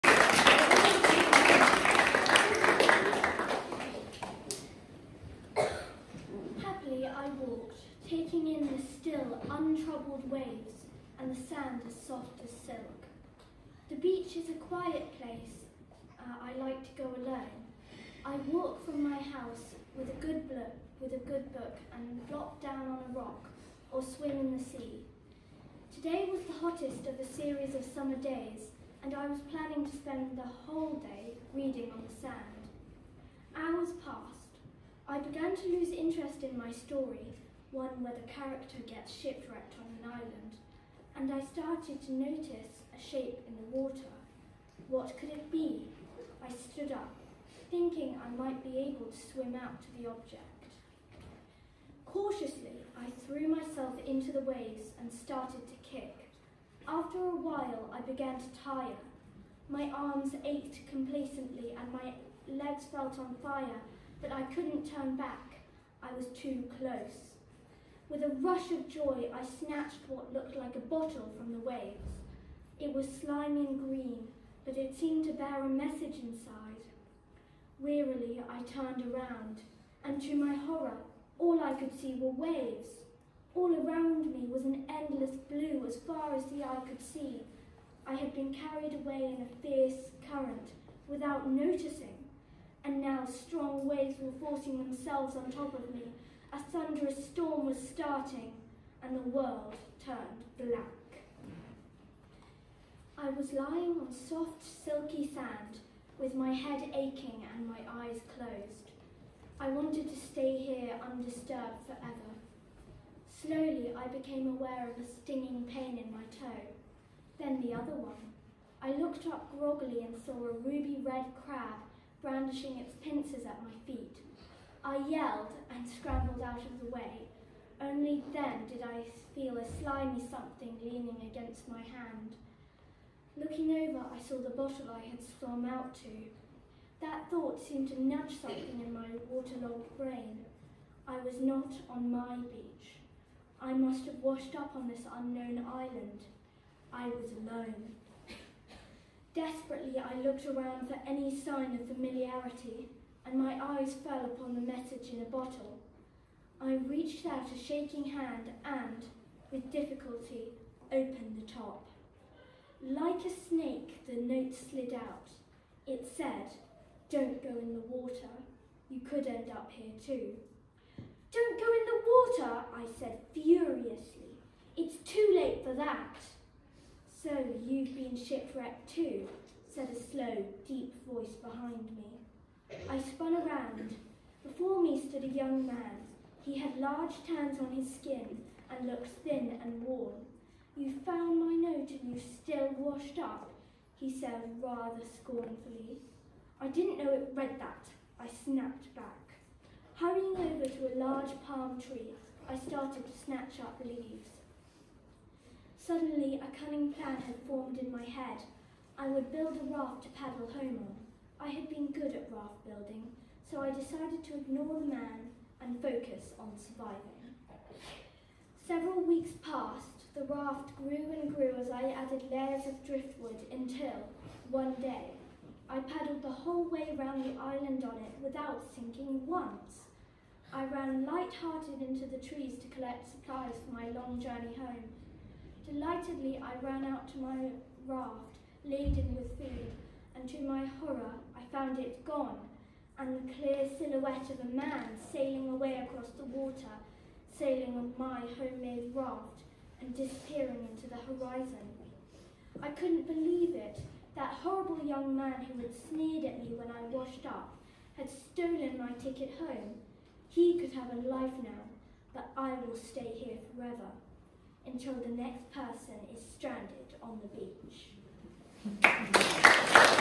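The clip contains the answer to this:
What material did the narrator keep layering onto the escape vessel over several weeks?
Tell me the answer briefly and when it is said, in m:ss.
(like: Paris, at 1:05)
Driftwood, at 3:42.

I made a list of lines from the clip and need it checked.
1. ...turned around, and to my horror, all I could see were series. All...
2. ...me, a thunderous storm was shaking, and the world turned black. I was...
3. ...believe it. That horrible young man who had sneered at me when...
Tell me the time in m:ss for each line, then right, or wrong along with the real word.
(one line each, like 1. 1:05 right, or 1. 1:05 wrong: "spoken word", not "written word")
1. 1:18 wrong: "waves", not "series"
2. 1:35 wrong: "starting", not "shaking"
3. 4:13 right.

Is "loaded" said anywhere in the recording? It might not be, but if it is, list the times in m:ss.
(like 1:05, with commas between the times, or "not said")
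not said.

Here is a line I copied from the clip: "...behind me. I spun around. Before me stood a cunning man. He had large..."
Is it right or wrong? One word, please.
wrong.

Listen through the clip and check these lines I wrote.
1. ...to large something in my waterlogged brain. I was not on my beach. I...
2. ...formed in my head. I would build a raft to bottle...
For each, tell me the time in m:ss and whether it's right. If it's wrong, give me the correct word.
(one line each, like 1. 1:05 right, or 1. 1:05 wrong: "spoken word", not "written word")
1. 2:17 wrong: "nudge", not "large"
2. 3:27 wrong: "paddle", not "bottle".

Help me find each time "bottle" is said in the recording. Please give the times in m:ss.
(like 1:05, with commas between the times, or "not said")
1:10, 2:14, 2:35.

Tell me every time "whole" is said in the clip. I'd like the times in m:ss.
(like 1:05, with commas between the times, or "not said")
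0:30, 3:46.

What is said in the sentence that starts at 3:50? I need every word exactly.
I ran light-hearted into the trees to collect supplies for my long journey home.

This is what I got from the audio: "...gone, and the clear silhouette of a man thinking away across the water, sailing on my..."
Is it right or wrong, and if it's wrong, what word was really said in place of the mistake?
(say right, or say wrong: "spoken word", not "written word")
wrong: "sailing", not "thinking".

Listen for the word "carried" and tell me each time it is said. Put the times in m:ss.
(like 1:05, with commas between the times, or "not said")
1:28.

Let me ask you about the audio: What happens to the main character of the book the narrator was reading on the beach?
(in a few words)
Gets shipwrecked on an island.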